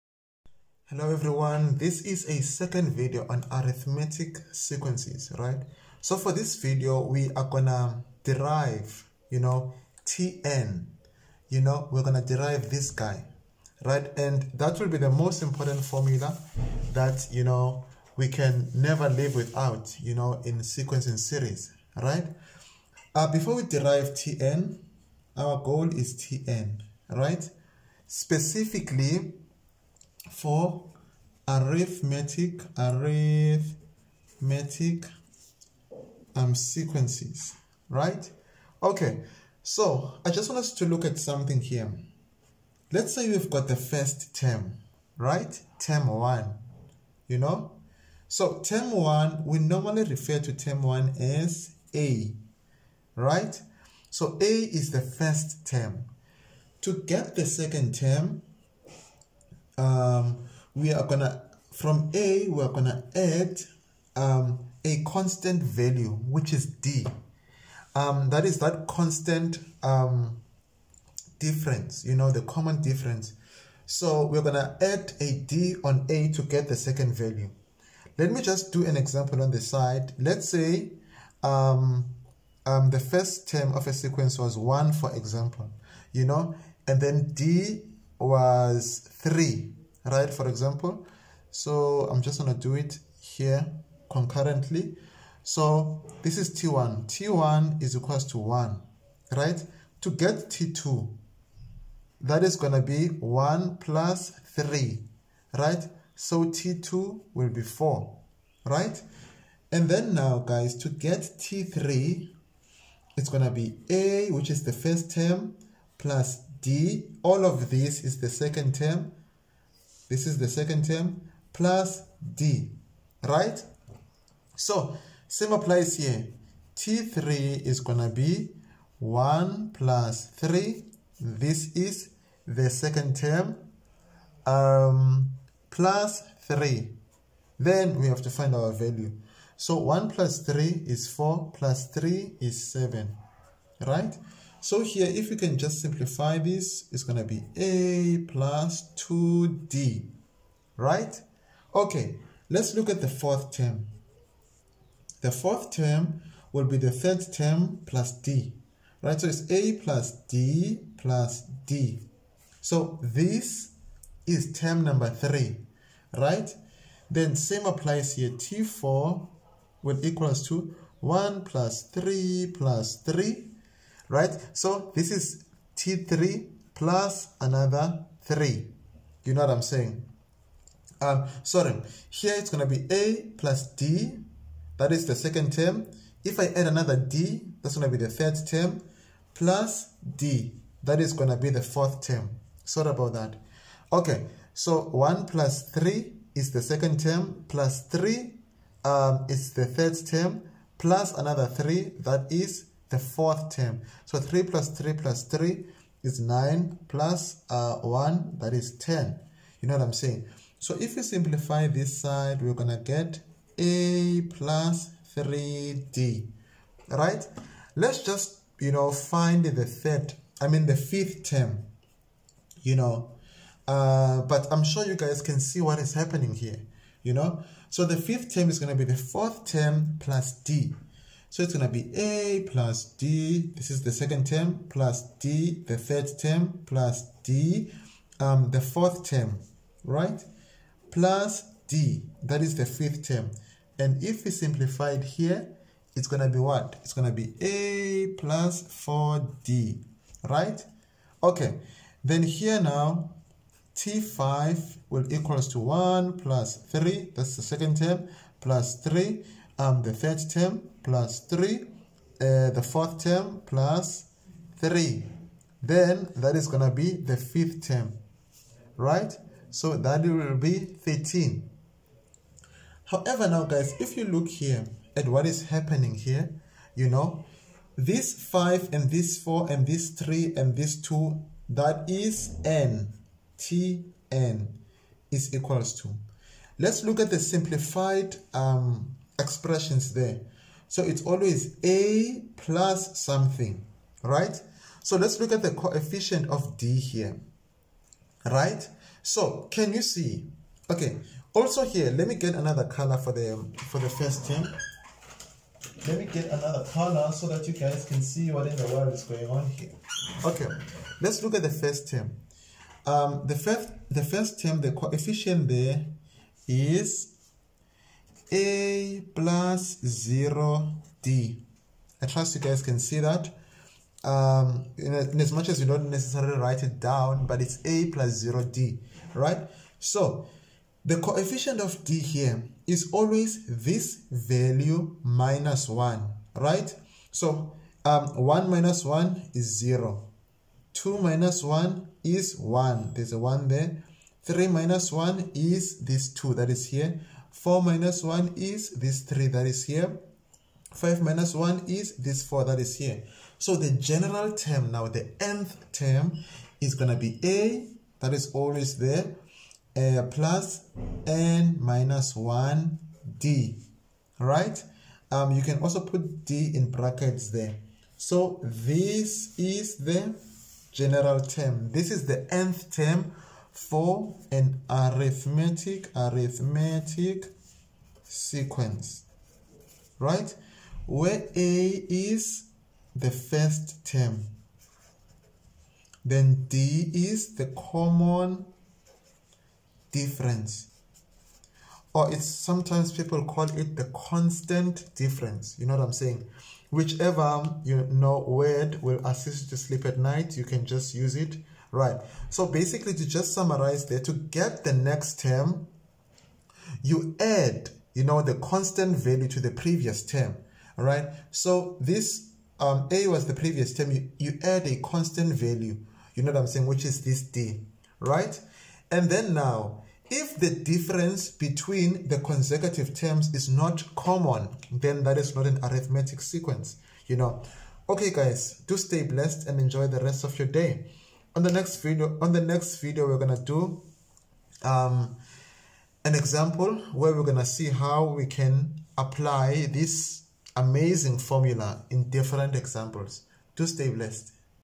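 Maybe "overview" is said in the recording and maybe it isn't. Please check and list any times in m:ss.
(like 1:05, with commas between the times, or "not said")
not said.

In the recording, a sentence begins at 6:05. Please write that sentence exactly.
Um, you can also put d in brackets there.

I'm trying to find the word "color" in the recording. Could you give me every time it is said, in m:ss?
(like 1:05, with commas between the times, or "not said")
5:02, 5:06.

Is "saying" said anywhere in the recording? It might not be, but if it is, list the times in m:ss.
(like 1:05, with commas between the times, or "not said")
2:59, 3:29, 6:35, 6:56.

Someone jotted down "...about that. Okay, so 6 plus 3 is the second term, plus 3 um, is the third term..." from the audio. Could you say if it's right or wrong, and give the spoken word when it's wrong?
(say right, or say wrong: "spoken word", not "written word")
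wrong: "1", not "6".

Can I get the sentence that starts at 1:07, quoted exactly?
Um, that is that constant um, difference, you know, the common difference.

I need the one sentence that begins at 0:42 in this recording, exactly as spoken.
Let's say we've got the first term, right?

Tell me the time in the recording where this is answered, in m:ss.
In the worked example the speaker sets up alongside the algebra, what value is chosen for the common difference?
1:27.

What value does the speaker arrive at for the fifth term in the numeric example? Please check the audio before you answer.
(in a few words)
13.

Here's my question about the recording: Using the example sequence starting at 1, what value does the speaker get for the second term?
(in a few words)
4.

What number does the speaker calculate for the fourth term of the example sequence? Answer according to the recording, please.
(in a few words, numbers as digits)
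10.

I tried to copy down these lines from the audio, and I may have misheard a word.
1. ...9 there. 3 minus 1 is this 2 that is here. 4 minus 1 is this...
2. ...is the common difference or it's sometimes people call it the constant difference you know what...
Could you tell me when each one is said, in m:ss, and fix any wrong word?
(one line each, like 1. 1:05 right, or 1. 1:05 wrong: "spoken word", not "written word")
1. 5:43 wrong: "1", not "9"
2. 6:26 right.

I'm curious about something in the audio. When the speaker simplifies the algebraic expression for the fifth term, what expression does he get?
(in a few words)
A plus 4D.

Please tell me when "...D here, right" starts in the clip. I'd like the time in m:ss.
4:56.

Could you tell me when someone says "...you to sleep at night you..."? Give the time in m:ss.
6:39.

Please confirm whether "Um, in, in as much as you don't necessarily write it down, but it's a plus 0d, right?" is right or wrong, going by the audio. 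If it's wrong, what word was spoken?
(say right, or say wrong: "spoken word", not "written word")
right.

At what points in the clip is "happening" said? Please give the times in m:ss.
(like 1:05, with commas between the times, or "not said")
3:45, 4:35.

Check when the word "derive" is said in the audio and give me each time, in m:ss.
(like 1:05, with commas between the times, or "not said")
0:08, 0:12, 0:23.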